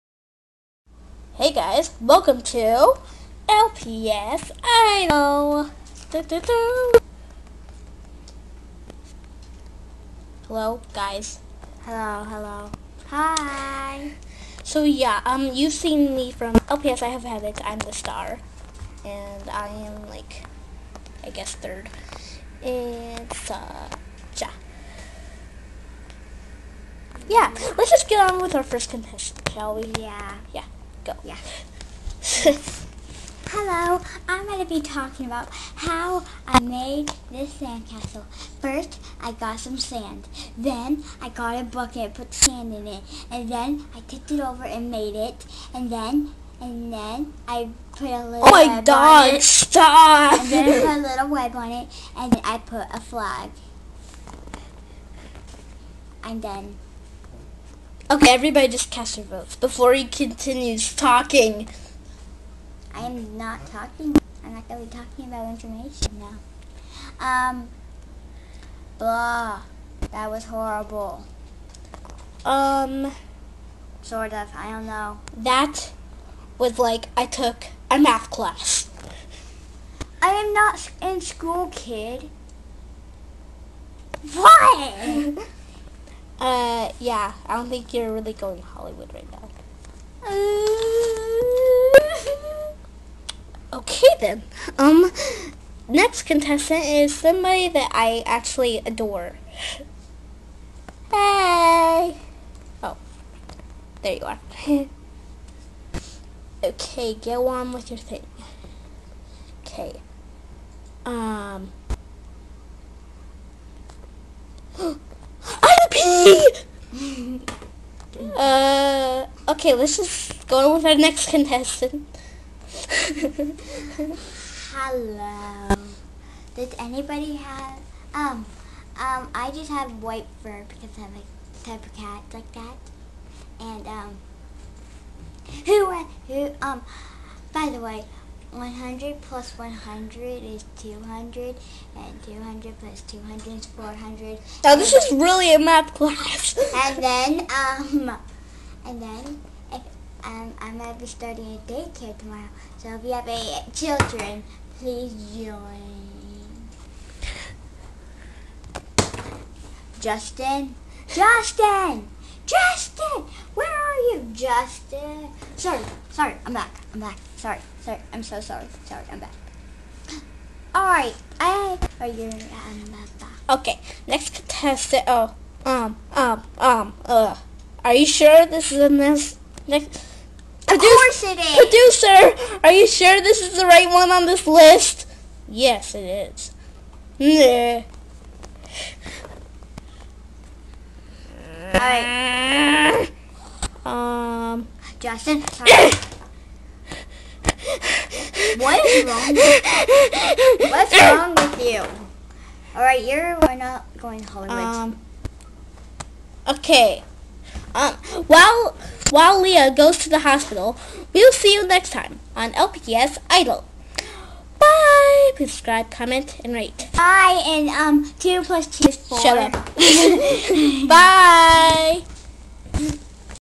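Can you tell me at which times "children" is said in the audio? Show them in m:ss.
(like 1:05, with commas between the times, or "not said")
2:33.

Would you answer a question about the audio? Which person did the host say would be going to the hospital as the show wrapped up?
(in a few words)
Leah.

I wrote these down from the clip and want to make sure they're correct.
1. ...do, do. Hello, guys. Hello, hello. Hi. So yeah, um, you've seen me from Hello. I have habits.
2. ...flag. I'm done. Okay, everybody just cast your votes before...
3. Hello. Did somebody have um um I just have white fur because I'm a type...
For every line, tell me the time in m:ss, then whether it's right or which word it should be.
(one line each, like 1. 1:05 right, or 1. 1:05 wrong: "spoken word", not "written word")
1. 0:06 wrong: "LPS", not "Hello"
2. 0:53 right
3. 2:04 wrong: "anybody", not "somebody".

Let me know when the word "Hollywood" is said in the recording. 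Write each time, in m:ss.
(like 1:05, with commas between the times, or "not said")
1:28, 3:24.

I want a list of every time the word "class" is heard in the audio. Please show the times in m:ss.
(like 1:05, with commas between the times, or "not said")
1:18, 2:25.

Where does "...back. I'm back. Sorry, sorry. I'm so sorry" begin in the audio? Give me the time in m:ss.
2:46.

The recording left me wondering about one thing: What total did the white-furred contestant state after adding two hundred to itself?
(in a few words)
400.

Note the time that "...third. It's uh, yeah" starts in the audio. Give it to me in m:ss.
0:21.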